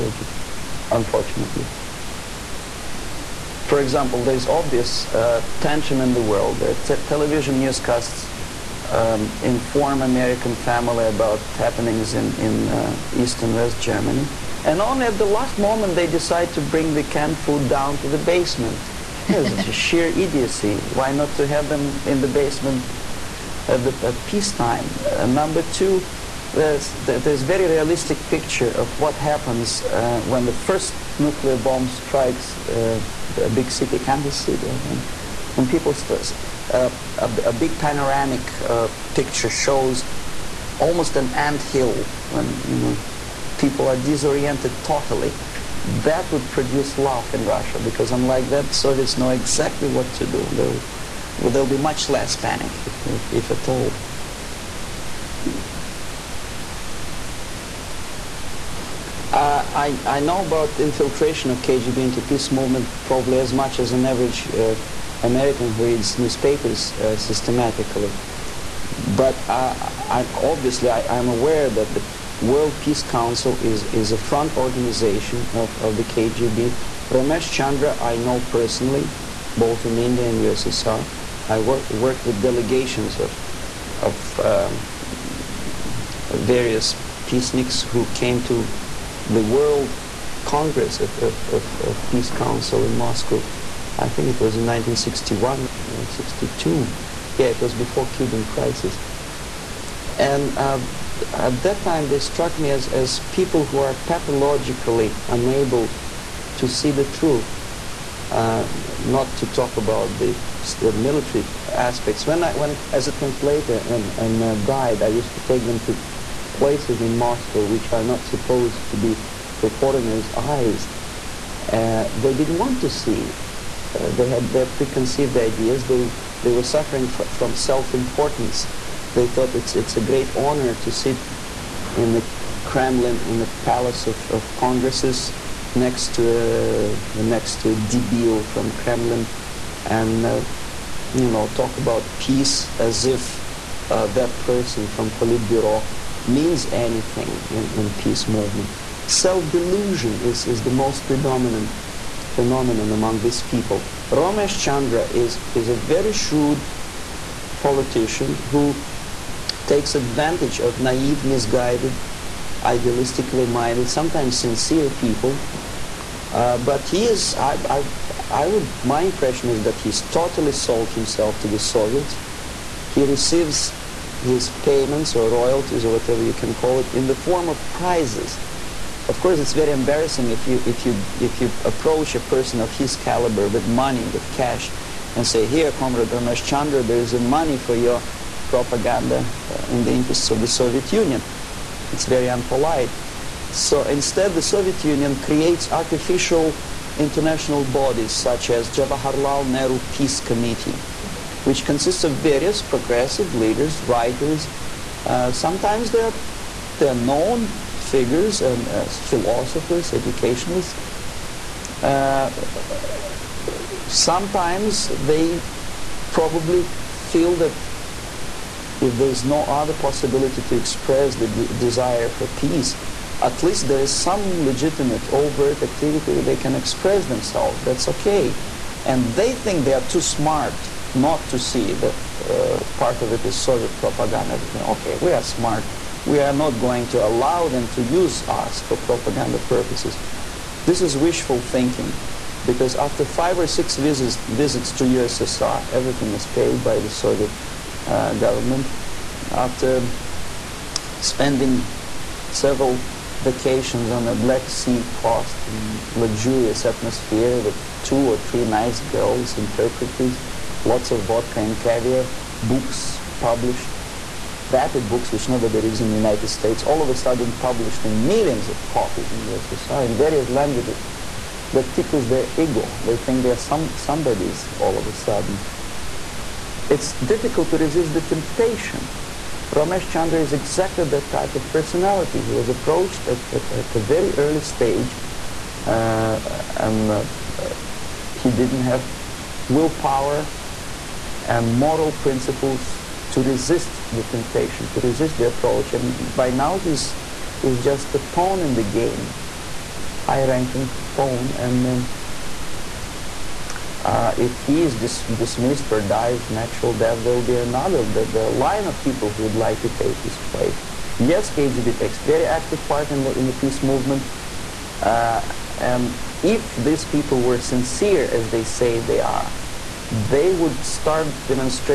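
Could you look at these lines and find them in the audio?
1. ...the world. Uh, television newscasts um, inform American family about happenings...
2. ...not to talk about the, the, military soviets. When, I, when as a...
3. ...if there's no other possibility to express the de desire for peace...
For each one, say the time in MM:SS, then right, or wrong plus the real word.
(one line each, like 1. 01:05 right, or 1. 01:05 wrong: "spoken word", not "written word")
1. 00:06 right
2. 01:48 wrong: "aspects", not "soviets"
3. 03:38 right.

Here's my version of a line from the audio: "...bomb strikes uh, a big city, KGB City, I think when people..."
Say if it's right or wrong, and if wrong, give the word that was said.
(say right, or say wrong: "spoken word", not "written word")
wrong: "Kansas", not "KGB".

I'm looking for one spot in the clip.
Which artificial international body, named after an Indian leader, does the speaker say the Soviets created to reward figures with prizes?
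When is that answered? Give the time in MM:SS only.
03:18.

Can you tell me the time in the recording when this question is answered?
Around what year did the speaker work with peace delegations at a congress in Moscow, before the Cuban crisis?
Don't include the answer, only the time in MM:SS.
01:34.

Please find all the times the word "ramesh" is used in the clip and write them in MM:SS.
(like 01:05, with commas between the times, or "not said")
01:17, 02:34, 03:06, 04:39.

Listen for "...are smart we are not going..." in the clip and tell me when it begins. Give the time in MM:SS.
03:55.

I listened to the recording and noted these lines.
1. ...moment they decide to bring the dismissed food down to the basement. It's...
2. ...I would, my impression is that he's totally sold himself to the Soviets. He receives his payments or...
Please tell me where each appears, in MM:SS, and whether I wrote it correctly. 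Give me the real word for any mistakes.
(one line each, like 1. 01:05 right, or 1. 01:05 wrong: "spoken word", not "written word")
1. 00:15 wrong: "canned", not "dismissed"
2. 02:48 right.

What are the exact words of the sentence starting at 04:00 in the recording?
This is wishful thinking because after five or six visits, visits to USSR, everything is paid by the Soviet uh, government.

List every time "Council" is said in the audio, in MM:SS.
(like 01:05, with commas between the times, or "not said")
01:13, 01:32.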